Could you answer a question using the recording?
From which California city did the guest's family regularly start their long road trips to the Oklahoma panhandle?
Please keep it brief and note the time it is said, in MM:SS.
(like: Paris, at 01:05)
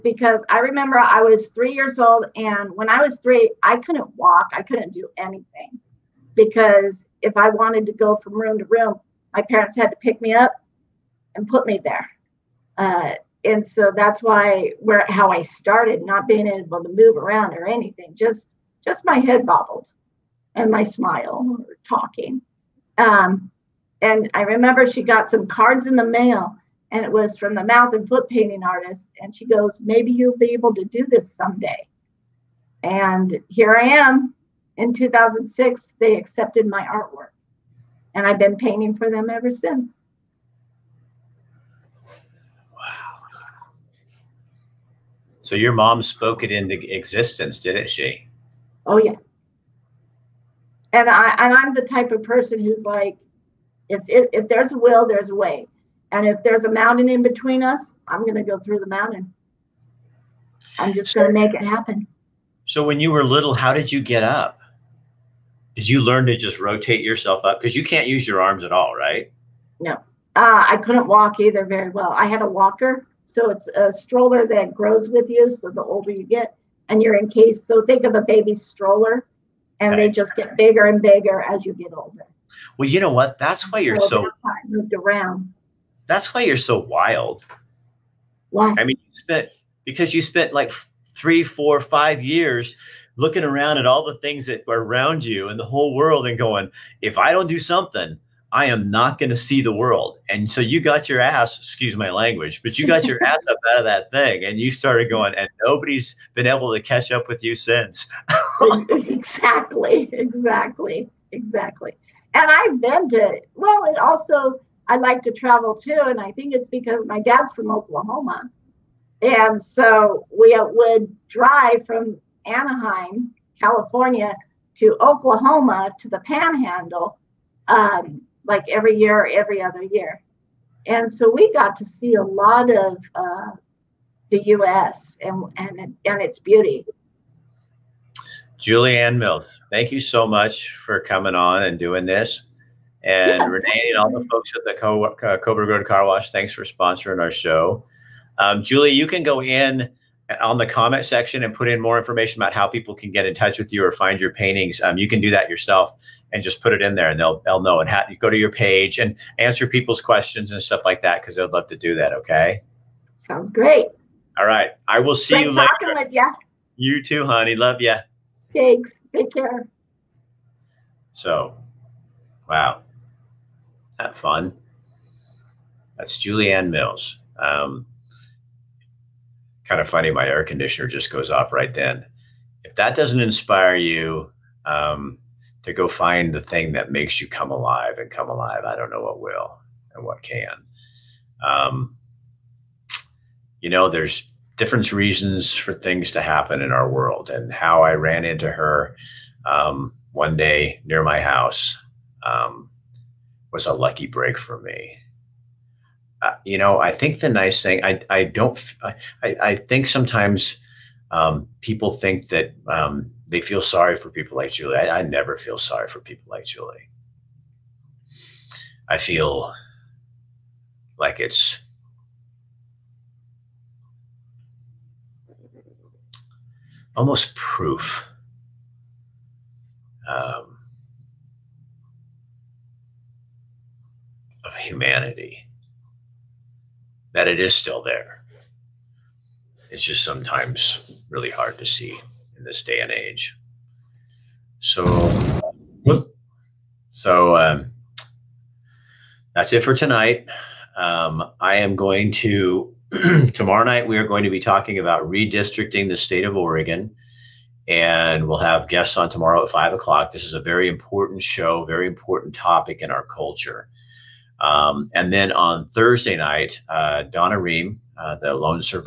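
Anaheim, at 02:02.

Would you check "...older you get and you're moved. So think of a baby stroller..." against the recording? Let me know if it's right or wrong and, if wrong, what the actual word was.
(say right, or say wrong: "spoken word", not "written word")
wrong: "encased", not "moved".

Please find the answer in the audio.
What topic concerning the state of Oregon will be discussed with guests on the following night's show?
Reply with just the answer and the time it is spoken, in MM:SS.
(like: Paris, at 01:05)
Redistricting, at 04:15.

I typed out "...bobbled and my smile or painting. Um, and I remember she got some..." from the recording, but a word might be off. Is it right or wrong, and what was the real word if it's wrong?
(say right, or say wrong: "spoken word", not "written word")
wrong: "talking", not "painting".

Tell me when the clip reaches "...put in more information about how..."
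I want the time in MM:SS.
02:31.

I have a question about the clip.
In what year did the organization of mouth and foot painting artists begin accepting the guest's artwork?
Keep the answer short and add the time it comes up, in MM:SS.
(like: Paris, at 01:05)
2006, at 00:34.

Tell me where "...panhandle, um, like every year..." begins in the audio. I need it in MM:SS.
02:06.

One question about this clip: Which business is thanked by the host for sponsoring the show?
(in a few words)
Coburg Road Car Wash.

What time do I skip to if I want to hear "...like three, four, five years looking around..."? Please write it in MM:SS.
01:30.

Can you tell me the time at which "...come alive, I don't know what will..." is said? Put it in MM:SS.
03:08.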